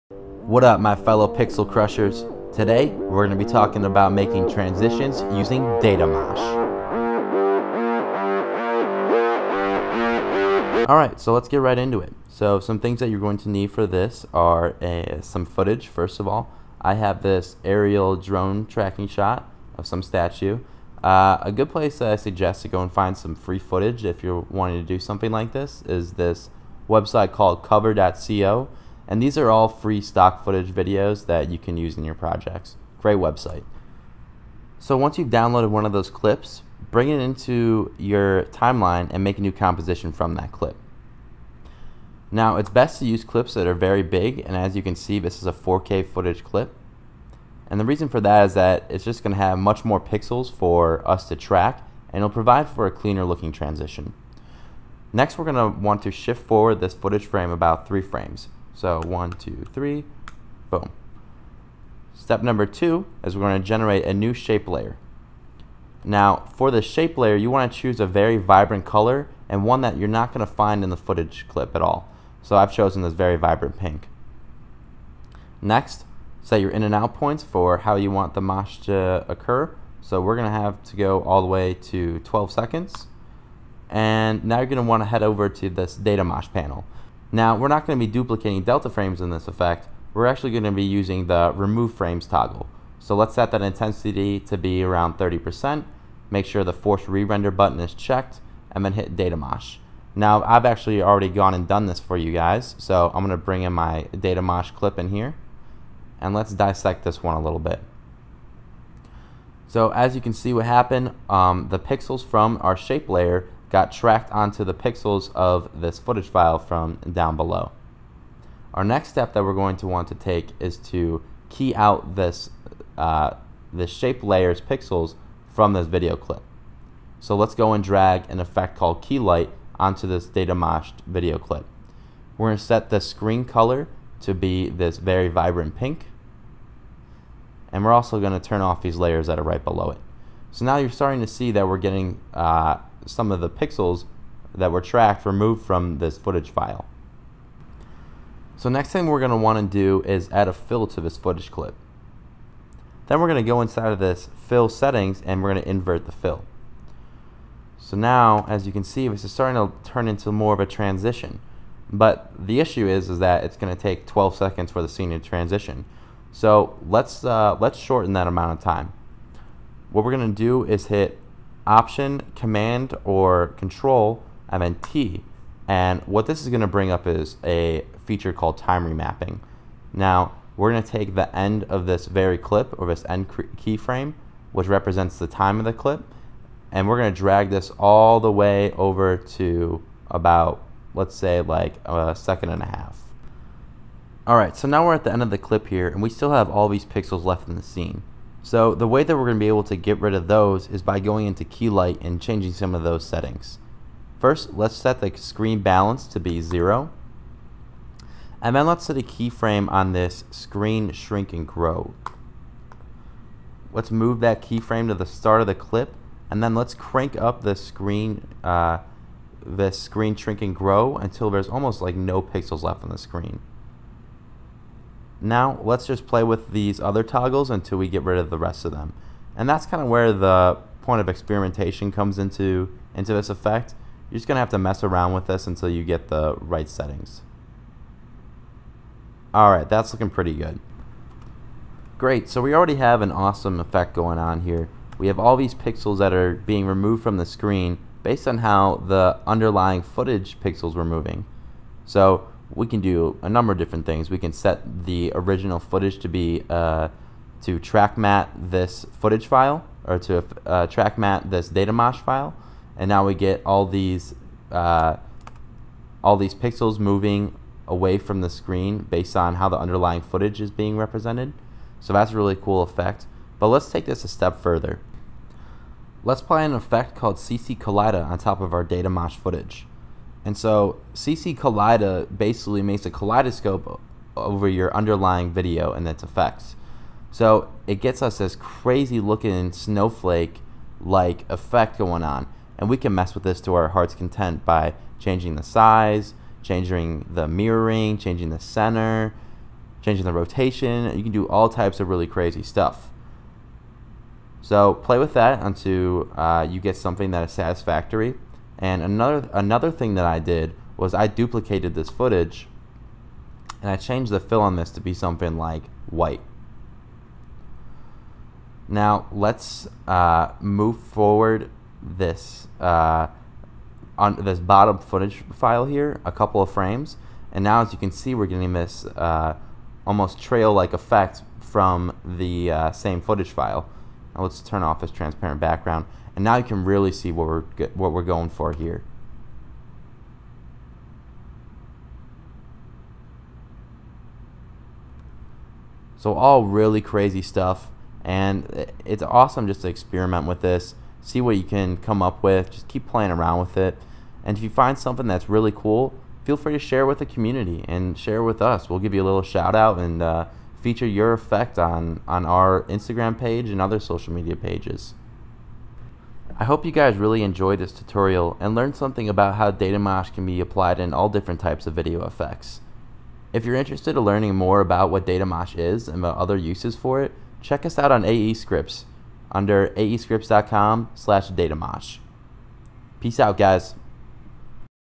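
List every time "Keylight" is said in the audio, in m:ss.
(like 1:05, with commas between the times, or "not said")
2:09, 3:21.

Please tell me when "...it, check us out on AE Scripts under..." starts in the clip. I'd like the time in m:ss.
6:17.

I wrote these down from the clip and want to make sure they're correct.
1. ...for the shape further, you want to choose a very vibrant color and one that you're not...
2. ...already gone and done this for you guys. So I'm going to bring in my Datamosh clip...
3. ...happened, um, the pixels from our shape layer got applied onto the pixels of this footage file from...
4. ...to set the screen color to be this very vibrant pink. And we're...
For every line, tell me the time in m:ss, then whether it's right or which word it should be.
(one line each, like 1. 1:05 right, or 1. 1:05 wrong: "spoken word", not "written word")
1. 1:06 wrong: "layer", not "further"
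2. 1:41 right
3. 1:50 wrong: "tracked", not "applied"
4. 2:12 right.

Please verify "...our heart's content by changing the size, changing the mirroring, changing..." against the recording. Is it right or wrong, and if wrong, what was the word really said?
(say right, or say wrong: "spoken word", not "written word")
right.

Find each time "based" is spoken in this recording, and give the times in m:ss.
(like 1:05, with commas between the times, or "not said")
4:08, 4:28.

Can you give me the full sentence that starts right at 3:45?
Now let's just play with these other toggles until we get rid of the rest of them.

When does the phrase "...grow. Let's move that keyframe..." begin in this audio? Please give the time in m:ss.
3:31.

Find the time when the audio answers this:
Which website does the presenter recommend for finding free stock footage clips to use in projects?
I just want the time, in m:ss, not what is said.
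0:27.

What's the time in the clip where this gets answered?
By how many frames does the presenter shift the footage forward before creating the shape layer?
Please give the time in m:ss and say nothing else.
0:57.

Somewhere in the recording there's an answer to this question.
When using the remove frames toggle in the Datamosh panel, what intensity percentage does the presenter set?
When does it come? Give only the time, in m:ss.
1:35.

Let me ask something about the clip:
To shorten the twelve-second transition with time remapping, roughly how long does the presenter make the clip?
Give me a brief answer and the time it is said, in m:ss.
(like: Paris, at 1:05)
a second and a half, at 3:11.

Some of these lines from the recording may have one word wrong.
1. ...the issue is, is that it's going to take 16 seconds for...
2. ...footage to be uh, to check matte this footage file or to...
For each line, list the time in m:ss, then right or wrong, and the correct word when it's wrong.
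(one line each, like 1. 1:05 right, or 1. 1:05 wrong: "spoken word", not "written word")
1. 2:42 wrong: "12", not "16"
2. 4:15 wrong: "track", not "check".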